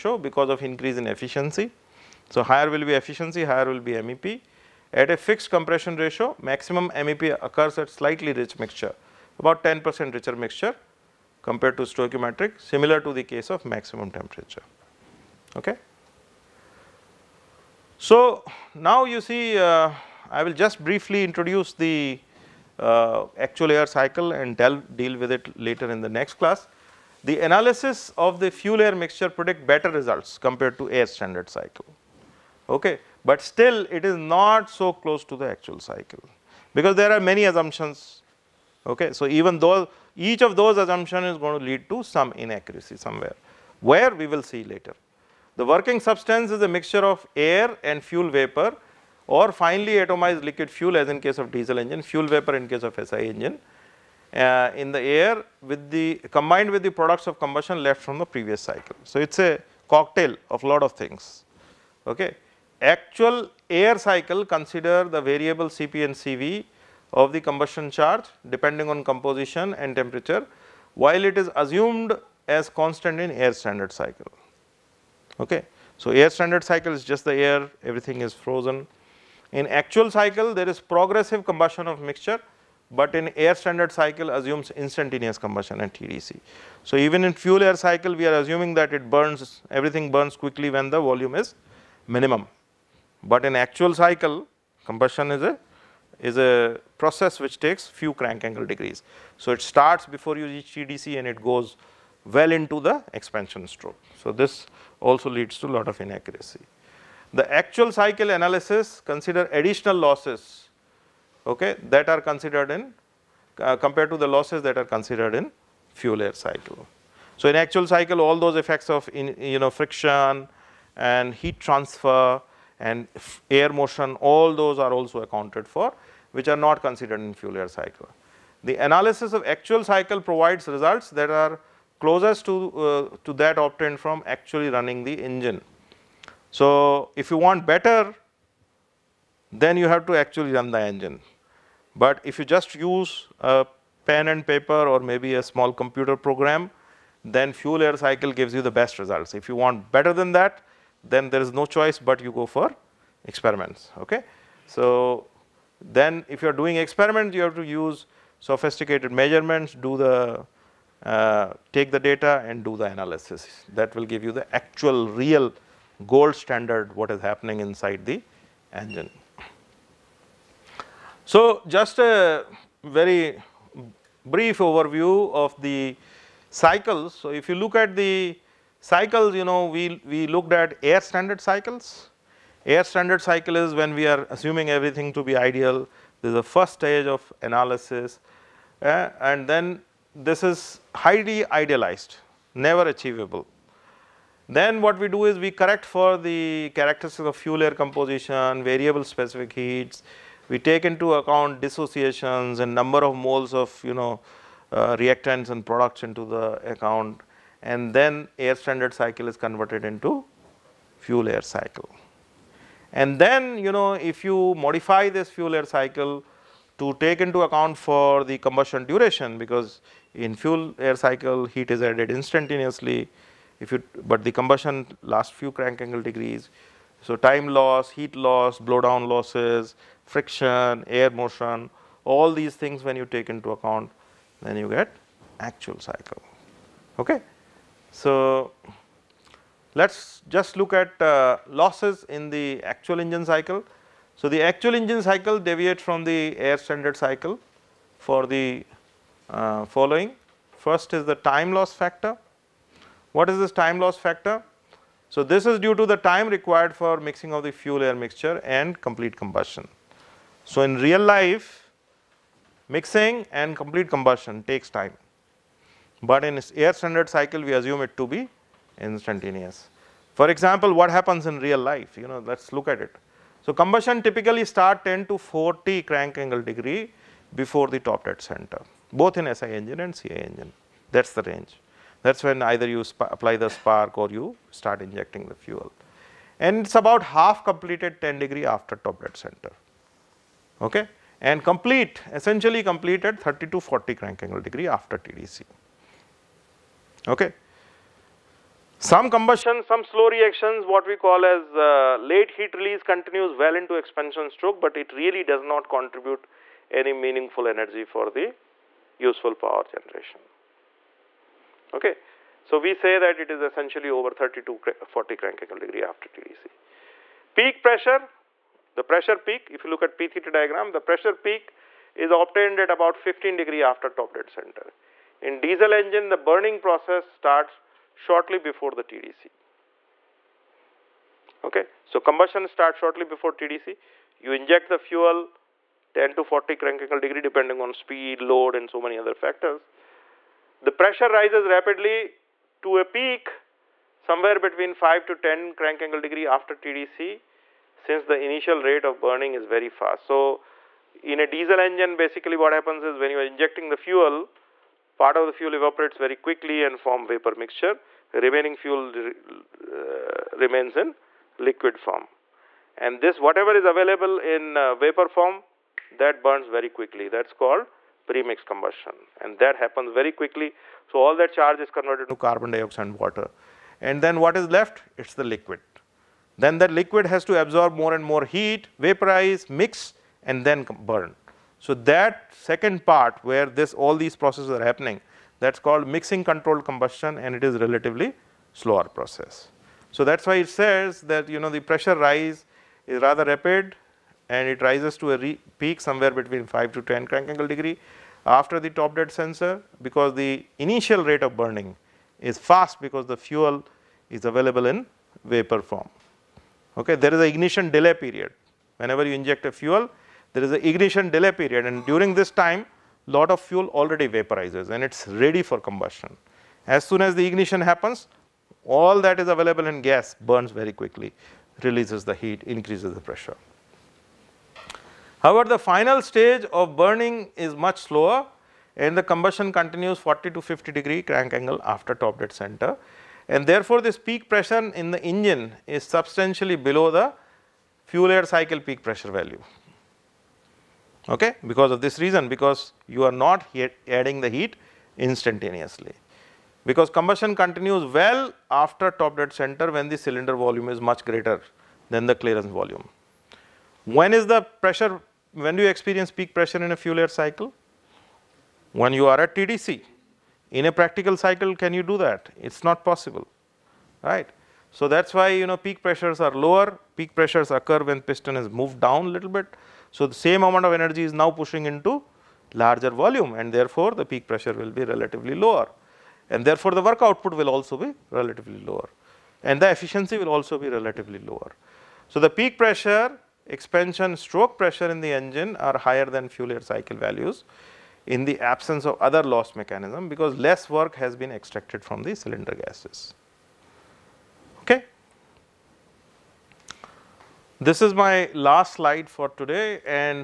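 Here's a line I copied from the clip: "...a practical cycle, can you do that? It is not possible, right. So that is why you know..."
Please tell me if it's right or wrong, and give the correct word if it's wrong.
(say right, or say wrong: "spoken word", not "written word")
right.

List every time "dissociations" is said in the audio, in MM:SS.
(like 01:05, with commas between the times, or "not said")
03:21.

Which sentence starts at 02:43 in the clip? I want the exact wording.
That will give you the actual real gold standard what is happening inside the engine.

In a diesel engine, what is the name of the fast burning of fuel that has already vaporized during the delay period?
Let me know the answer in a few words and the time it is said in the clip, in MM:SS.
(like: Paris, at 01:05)
premix combustion, at 06:08.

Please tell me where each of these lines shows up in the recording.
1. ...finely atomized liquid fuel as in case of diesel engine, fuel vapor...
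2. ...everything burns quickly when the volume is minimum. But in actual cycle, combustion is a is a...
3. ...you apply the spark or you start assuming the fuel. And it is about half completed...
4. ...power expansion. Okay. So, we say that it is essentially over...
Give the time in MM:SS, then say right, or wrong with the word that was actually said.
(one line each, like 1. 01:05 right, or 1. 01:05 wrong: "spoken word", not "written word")
1. 00:49 right
2. 01:29 right
3. 04:42 wrong: "injecting", not "assuming"
4. 05:09 wrong: "generation", not "expansion".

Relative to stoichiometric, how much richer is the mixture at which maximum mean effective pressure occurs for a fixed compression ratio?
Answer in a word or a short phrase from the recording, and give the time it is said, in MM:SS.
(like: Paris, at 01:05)
10 percent, at 00:09.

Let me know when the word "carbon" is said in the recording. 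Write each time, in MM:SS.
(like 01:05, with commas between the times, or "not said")
06:12.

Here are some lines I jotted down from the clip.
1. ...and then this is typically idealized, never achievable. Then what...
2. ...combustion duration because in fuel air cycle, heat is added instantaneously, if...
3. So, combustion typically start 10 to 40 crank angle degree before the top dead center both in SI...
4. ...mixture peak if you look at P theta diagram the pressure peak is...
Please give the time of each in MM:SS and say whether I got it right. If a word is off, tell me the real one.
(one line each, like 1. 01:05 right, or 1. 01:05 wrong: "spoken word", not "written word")
1. 03:09 wrong: "highly", not "typically"
2. 03:38 right
3. 04:33 right
4. 05:18 wrong: "pressure", not "mixture".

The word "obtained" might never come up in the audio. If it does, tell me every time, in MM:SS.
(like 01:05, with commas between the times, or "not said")
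02:13, 05:22.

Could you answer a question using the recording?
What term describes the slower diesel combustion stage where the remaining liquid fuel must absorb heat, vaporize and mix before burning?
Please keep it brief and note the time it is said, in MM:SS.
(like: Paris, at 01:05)
mixing controlled combustion, at 06:25.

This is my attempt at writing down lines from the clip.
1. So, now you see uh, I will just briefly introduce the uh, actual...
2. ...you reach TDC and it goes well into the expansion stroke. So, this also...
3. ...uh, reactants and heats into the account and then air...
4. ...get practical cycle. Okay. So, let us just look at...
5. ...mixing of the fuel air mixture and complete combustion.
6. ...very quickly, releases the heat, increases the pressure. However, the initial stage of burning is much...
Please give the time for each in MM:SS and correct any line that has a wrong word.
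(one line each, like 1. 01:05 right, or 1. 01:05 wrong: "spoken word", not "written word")
1. 00:18 right
2. 01:40 right
3. 03:24 wrong: "products", not "heats"
4. 03:54 wrong: "actual", not "practical"
5. 04:16 right
6. 07:00 wrong: "final", not "initial".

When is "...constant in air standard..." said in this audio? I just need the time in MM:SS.
01:12.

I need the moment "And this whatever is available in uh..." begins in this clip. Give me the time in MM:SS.
06:02.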